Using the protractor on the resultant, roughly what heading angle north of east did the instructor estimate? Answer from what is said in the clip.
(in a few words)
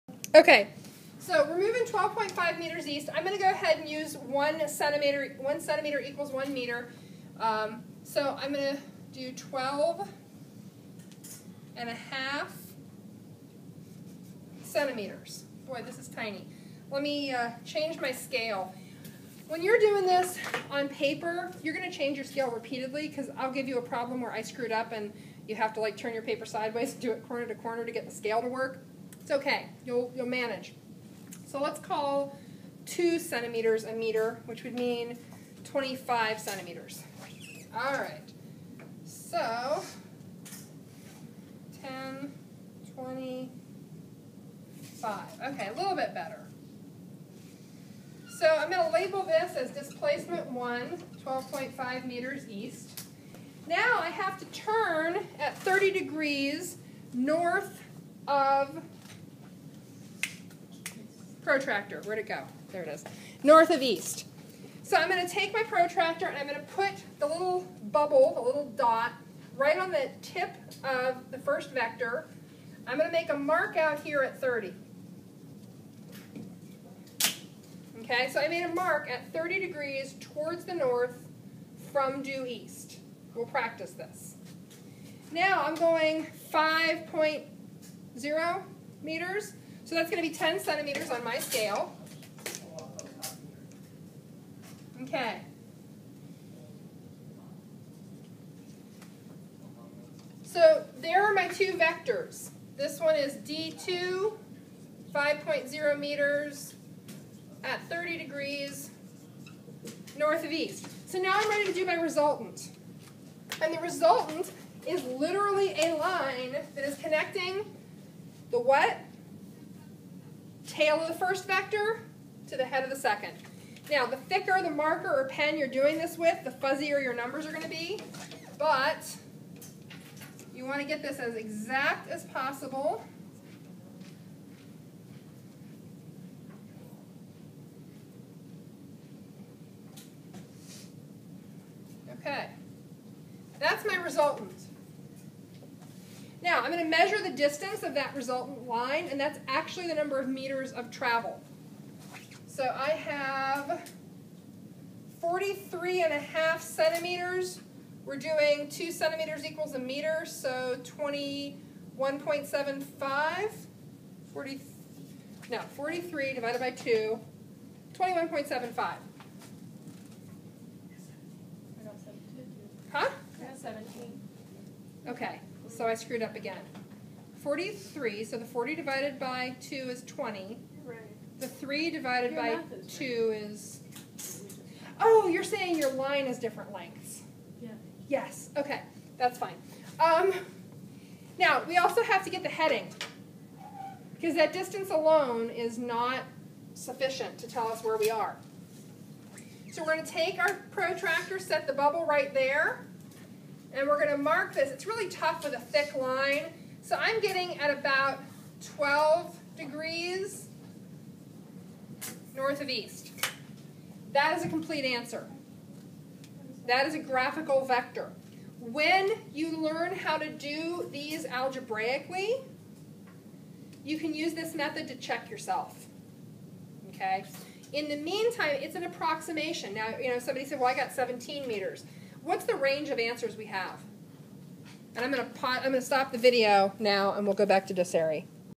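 12 degrees.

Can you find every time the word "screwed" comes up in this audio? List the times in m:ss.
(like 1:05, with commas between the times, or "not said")
0:24, 2:55.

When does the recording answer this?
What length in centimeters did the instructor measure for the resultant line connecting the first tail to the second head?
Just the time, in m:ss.
2:35.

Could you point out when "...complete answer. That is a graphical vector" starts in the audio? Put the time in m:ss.
3:34.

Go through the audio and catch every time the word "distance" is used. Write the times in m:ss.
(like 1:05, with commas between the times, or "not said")
2:27, 3:14.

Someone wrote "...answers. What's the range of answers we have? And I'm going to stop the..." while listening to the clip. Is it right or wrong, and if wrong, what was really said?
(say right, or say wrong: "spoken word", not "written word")
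wrong: "meters", not "answers".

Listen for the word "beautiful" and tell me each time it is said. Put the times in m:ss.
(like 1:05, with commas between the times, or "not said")
not said.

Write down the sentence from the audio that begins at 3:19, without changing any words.
So we're going to take our protractor, set the bubble right there, and we're going to mark this.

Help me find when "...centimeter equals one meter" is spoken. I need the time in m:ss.
0:05.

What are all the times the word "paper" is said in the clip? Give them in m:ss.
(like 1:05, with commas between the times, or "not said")
0:20, 0:26.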